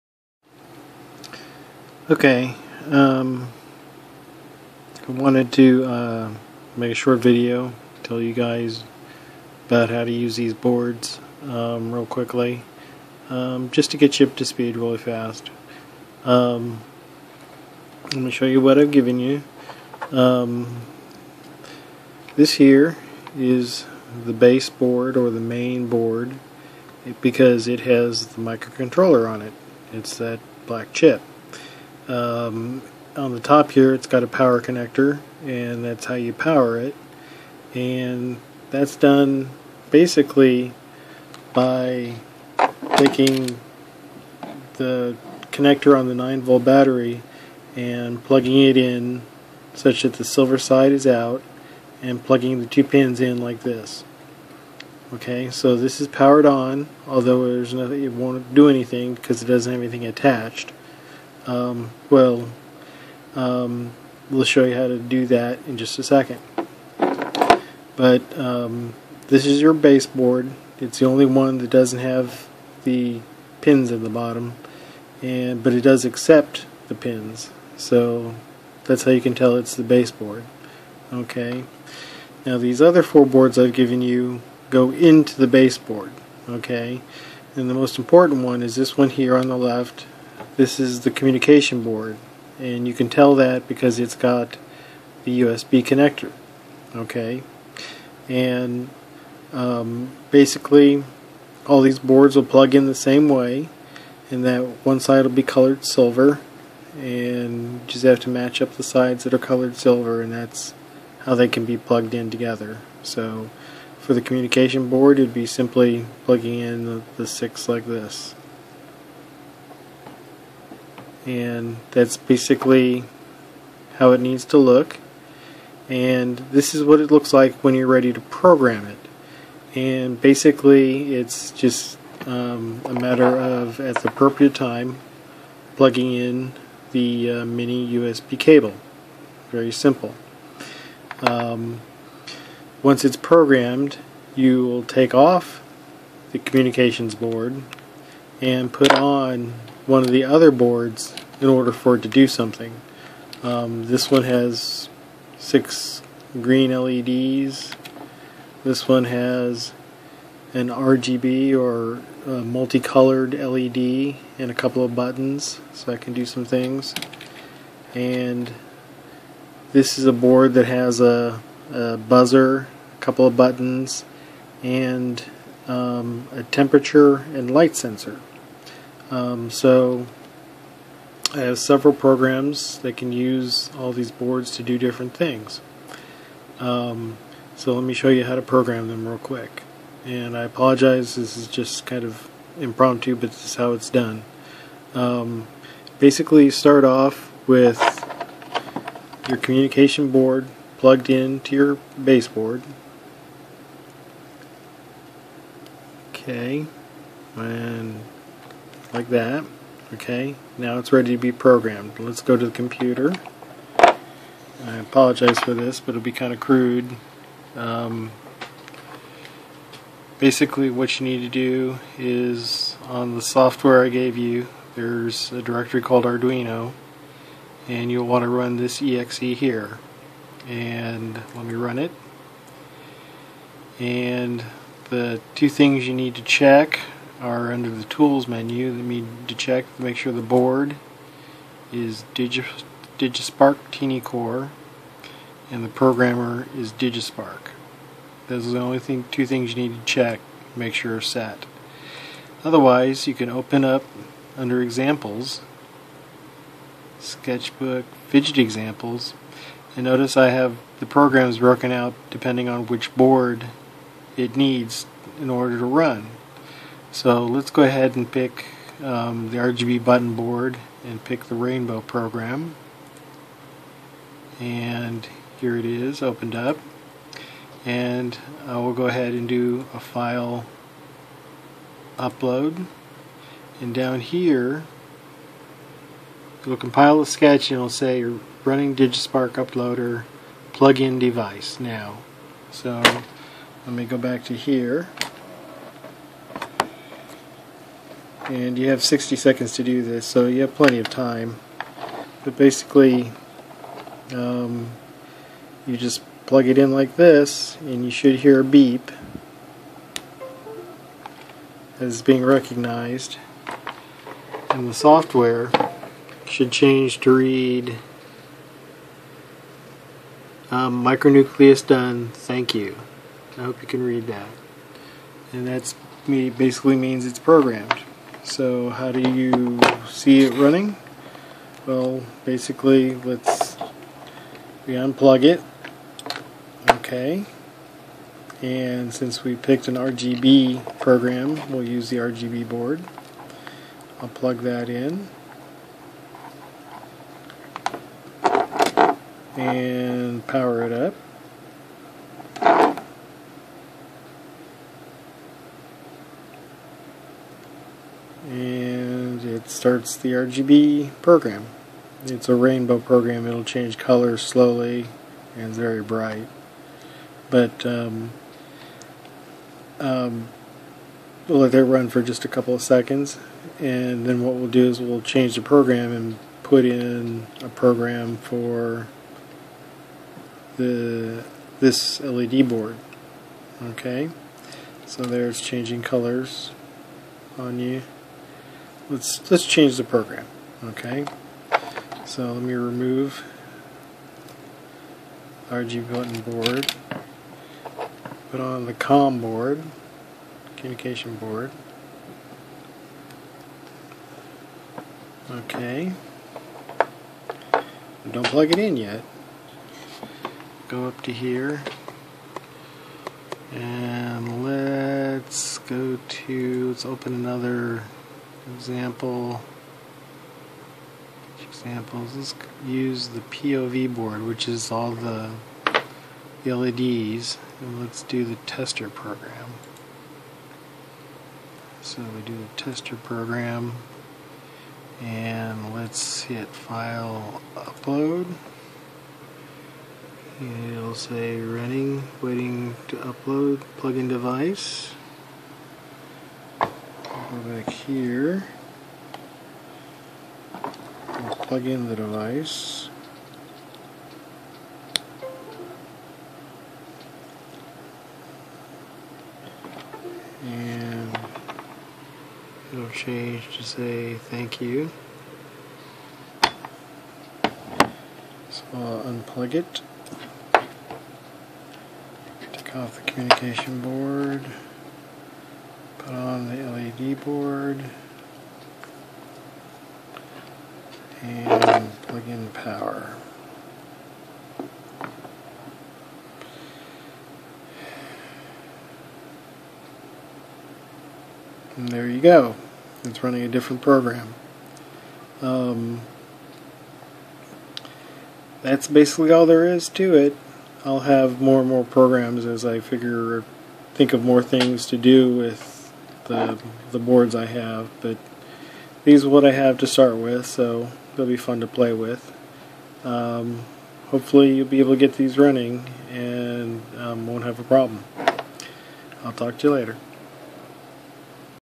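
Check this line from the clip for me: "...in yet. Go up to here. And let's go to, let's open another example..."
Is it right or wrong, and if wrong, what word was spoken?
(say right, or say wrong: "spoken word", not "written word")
right.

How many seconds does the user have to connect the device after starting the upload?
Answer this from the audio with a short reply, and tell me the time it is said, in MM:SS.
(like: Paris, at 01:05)
60, at 04:58.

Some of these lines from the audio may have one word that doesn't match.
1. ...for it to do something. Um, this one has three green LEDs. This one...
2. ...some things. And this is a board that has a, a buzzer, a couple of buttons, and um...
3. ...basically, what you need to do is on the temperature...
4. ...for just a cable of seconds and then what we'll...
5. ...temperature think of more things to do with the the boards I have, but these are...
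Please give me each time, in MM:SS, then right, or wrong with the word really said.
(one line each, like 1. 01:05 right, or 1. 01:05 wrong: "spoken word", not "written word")
1. 02:31 wrong: "six", not "three"
2. 02:46 right
3. 03:40 wrong: "software", not "temperature"
4. 06:11 wrong: "couple", not "cable"
5. 08:22 wrong: "figure", not "temperature".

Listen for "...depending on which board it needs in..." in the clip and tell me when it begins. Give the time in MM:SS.
04:22.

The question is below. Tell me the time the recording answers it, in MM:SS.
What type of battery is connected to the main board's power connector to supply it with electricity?
00:46.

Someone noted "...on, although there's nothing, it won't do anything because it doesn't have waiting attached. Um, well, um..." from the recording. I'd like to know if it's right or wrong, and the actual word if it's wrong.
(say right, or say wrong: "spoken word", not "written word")
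wrong: "anything", not "waiting".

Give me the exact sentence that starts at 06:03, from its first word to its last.
It'll change colors slowly and it's very bright.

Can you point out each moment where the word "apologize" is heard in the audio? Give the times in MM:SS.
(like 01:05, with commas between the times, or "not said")
03:10, 03:34.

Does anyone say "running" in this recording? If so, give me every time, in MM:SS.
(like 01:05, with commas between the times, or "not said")
04:48, 05:30, 07:21, 08:13, 08:35.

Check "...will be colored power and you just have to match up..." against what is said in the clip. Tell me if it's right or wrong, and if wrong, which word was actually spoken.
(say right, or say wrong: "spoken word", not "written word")
wrong: "silver", not "power".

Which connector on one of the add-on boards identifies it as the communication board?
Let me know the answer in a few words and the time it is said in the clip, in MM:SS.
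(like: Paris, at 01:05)
USB connector, at 01:35.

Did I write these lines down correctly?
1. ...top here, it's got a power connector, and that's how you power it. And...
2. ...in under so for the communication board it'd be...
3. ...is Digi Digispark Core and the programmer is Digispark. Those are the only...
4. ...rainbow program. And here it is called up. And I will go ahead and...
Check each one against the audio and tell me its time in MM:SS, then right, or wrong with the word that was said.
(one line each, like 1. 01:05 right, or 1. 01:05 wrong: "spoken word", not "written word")
1. 00:33 right
2. 01:52 wrong: "together", not "under"
3. 04:01 right
4. 04:31 wrong: "opened", not "called".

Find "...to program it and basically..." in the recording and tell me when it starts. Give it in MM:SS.
02:08.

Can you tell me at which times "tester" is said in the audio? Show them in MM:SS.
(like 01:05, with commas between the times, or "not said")
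07:08, 07:12.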